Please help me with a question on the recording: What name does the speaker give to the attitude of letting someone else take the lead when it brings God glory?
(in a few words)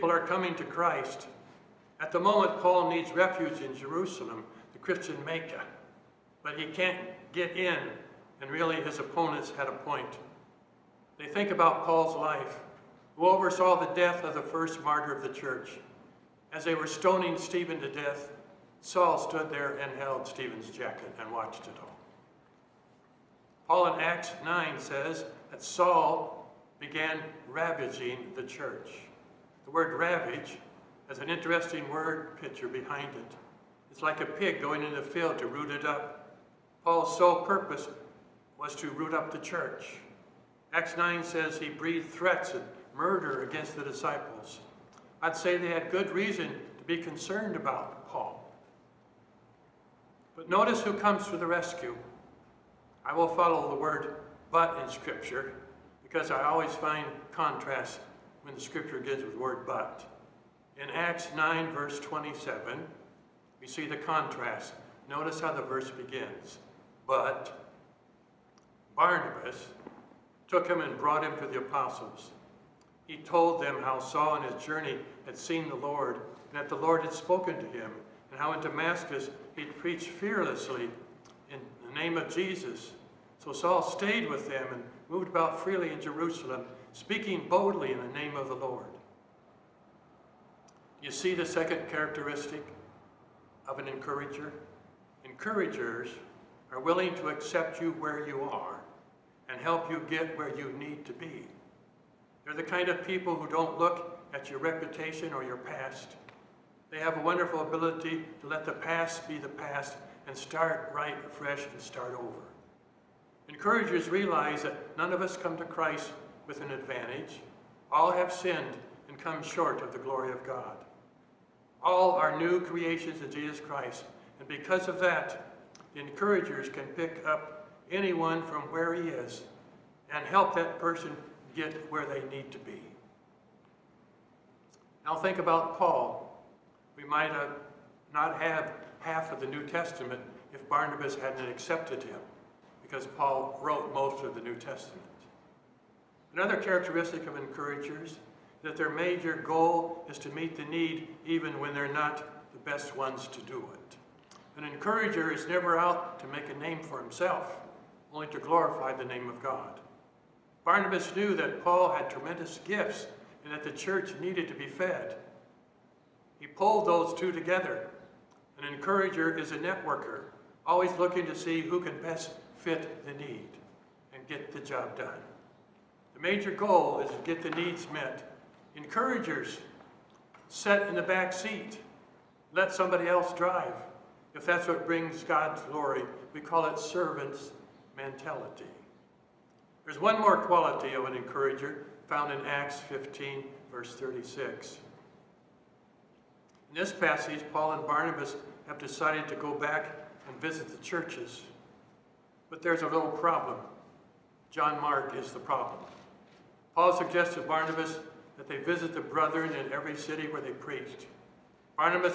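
Servant's mentality.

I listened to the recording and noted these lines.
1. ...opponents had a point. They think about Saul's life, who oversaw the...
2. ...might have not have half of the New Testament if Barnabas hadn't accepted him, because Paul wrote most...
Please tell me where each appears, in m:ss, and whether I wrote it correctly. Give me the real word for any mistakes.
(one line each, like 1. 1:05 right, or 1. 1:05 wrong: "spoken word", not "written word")
1. 0:08 wrong: "Paul", not "Saul"
2. 2:17 right.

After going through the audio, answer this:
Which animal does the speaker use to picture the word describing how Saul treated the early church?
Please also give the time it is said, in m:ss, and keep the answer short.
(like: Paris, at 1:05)
Pig, at 0:34.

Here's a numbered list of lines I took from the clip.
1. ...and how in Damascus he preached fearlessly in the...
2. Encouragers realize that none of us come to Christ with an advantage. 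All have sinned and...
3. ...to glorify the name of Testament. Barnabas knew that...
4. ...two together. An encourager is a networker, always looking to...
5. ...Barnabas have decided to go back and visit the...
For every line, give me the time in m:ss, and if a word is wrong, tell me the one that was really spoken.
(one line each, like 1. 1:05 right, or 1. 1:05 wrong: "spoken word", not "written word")
1. 1:18 right
2. 1:53 right
3. 2:38 wrong: "God", not "Testament"
4. 2:47 right
5. 3:17 right.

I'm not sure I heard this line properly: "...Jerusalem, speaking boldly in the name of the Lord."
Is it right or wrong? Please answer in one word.
right.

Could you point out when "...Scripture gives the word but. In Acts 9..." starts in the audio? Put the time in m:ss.
0:58.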